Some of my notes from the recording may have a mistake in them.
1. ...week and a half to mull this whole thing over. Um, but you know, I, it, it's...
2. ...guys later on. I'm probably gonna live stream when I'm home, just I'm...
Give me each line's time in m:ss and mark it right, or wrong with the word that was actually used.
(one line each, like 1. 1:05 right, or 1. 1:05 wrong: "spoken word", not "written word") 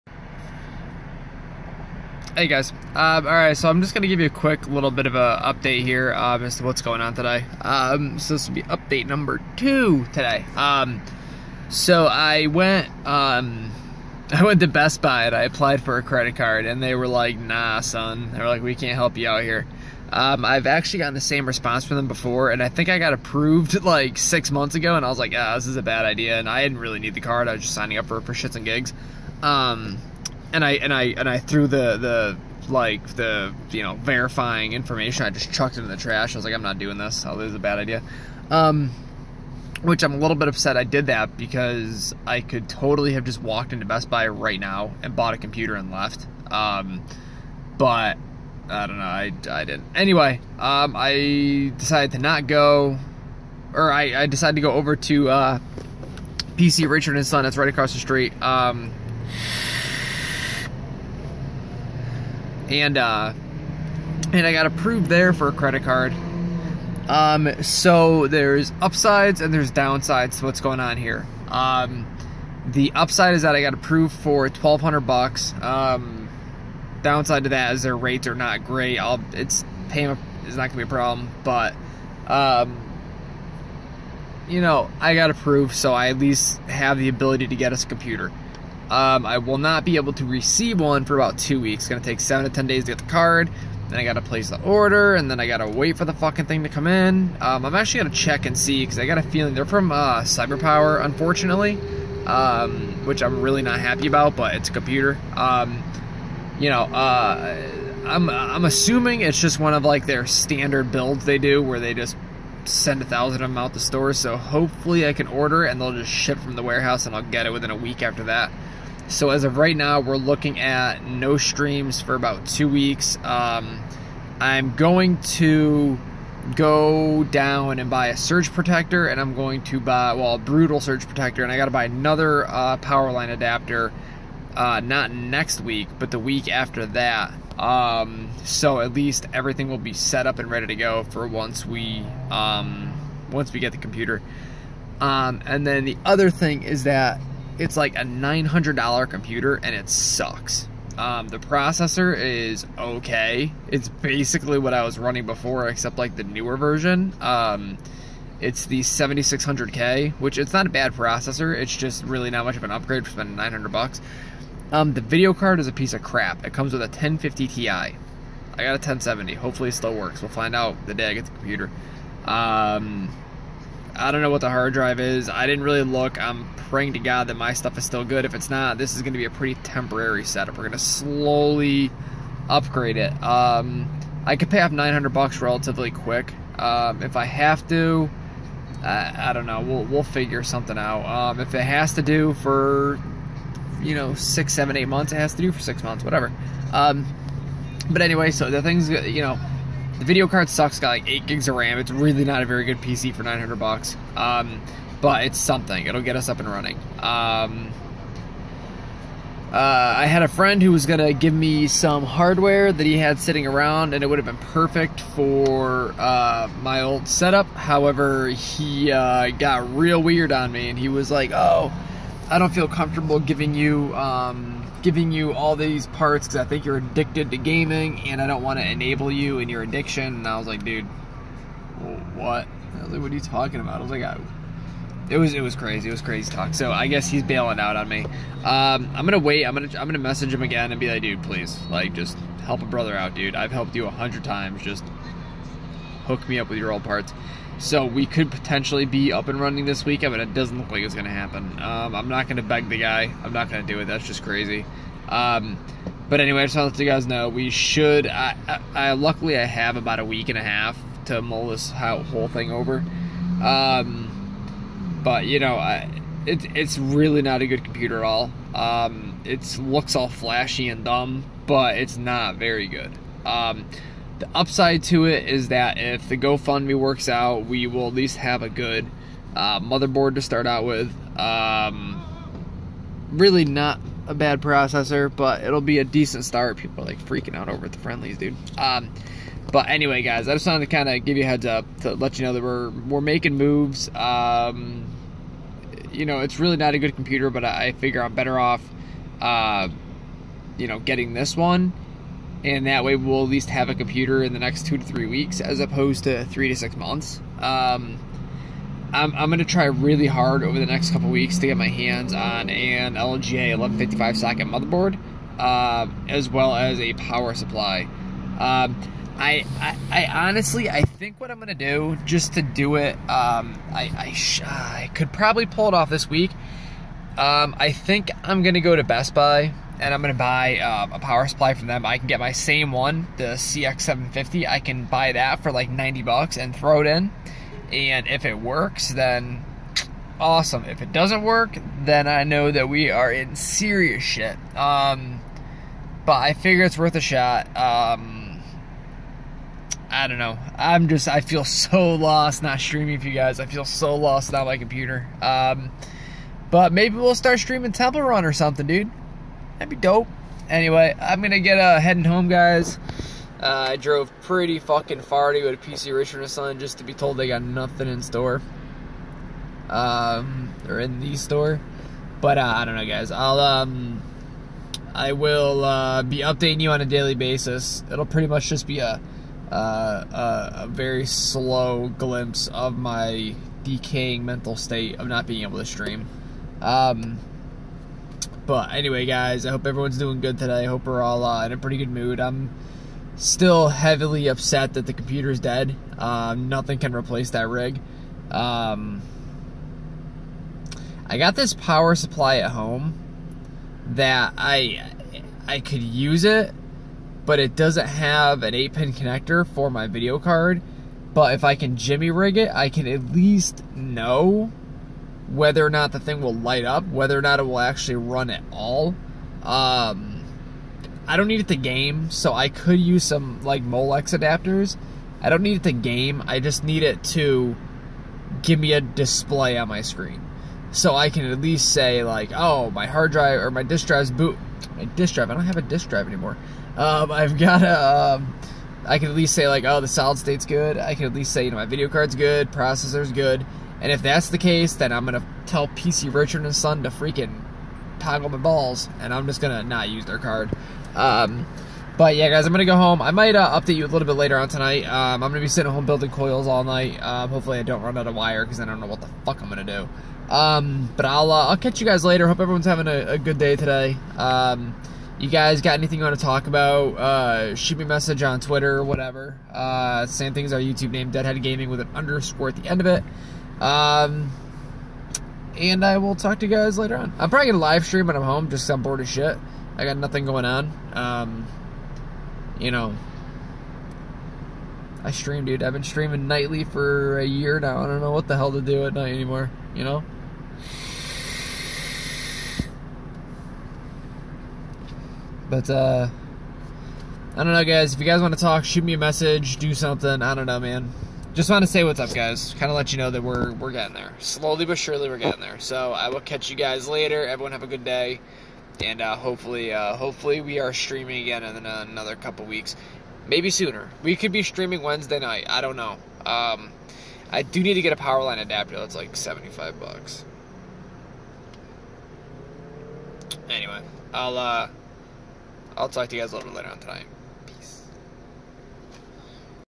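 1. 4:20 right
2. 7:56 right.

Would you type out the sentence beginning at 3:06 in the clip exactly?
Um, if I have to, I, I, don't know.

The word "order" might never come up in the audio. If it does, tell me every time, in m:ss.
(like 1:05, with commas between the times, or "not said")
1:34, 1:55.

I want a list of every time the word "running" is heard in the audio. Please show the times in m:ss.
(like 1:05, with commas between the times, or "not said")
2:34, 3:26, 4:09.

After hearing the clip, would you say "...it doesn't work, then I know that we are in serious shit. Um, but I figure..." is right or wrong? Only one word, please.
right.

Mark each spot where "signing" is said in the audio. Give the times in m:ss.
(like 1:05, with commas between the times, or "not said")
0:27.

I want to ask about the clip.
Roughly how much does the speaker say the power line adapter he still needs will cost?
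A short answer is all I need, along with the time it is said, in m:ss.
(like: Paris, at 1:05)
$75, at 8:39.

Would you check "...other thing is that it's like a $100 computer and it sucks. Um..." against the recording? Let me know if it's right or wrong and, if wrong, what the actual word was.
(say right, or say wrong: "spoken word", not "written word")
wrong: "900", not "100".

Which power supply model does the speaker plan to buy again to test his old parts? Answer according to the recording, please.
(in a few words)
CX750.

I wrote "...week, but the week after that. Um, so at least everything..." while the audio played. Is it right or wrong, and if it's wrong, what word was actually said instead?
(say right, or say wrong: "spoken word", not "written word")
right.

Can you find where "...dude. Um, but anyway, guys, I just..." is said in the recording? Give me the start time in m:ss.
4:48.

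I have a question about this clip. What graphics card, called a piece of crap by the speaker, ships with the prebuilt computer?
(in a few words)
1050 Ti.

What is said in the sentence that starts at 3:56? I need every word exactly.
So I guess he's bailing out on me.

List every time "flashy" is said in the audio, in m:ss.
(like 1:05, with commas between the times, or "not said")
4:30.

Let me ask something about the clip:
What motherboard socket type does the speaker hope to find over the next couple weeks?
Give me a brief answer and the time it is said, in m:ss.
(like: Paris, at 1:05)
LGA 1155, at 5:12.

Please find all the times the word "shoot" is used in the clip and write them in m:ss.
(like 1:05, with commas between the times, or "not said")
7:47, 8:18.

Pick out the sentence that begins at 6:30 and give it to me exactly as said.
I hope we're all uh, in a pretty good mood.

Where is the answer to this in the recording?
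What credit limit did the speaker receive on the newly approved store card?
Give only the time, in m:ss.
1:14.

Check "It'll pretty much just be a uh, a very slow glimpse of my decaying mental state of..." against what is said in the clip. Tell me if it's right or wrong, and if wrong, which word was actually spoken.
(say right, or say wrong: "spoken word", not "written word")
right.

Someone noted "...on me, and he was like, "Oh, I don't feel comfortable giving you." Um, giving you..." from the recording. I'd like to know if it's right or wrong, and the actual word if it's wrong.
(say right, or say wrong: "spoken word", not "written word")
right.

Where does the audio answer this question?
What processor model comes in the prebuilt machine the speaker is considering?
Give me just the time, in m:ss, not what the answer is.
2:38.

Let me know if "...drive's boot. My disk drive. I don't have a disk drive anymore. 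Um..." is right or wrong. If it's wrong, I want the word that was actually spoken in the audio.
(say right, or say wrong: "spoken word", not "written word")
right.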